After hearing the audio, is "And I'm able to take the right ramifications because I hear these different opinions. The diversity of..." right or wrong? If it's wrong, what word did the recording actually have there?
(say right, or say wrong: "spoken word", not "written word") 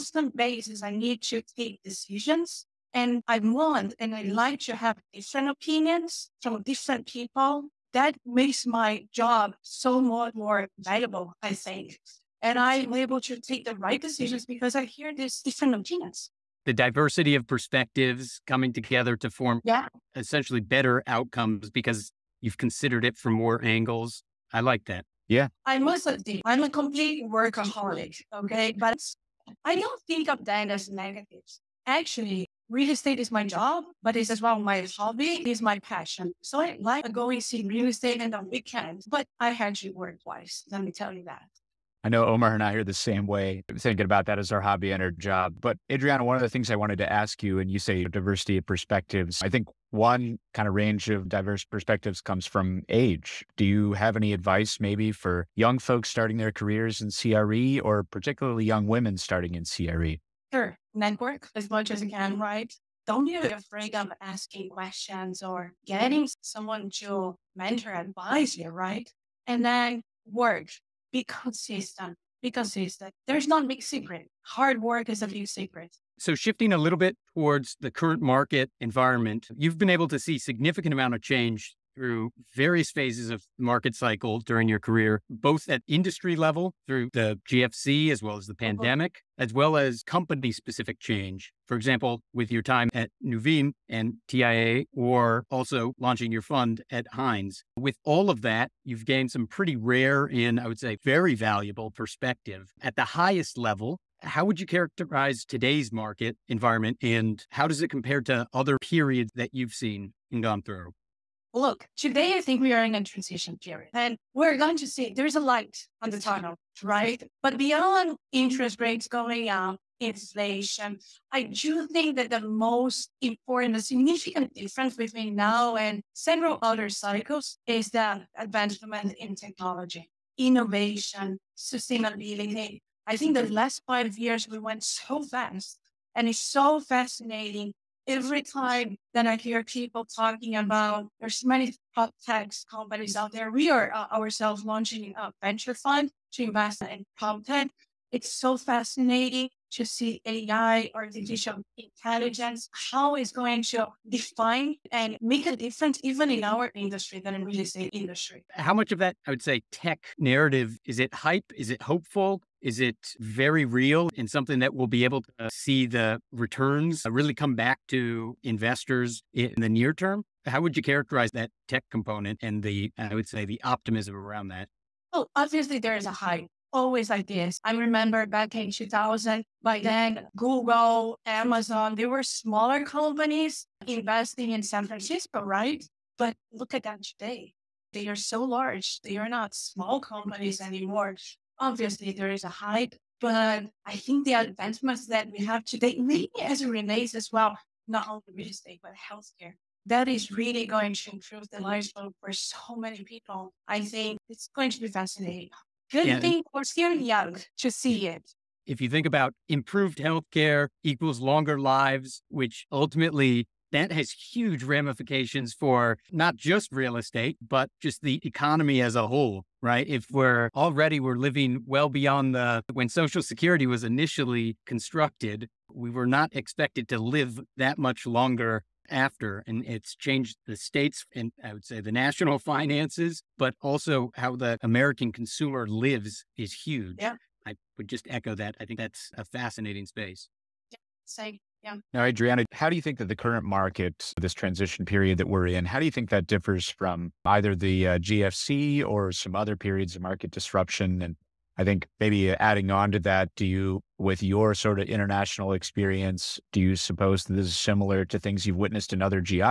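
wrong: "decisions", not "ramifications".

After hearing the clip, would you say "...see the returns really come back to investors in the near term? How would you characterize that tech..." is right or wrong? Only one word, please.
right.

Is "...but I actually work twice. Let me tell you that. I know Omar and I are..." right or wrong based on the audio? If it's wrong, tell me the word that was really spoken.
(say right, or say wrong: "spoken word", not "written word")
right.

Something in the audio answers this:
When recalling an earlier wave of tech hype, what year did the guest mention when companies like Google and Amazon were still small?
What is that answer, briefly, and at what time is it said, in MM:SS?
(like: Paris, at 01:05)
2000, at 02:58.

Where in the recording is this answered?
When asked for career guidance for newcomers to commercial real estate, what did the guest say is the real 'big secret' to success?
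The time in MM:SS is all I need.
01:14.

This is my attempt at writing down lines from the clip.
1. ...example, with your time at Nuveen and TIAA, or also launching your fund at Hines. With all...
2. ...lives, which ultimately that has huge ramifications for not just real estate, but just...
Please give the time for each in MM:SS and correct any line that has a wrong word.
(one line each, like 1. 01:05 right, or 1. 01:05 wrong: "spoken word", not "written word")
1. 01:31 right
2. 03:31 right.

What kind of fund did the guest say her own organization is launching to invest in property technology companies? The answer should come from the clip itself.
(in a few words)
A venture fund.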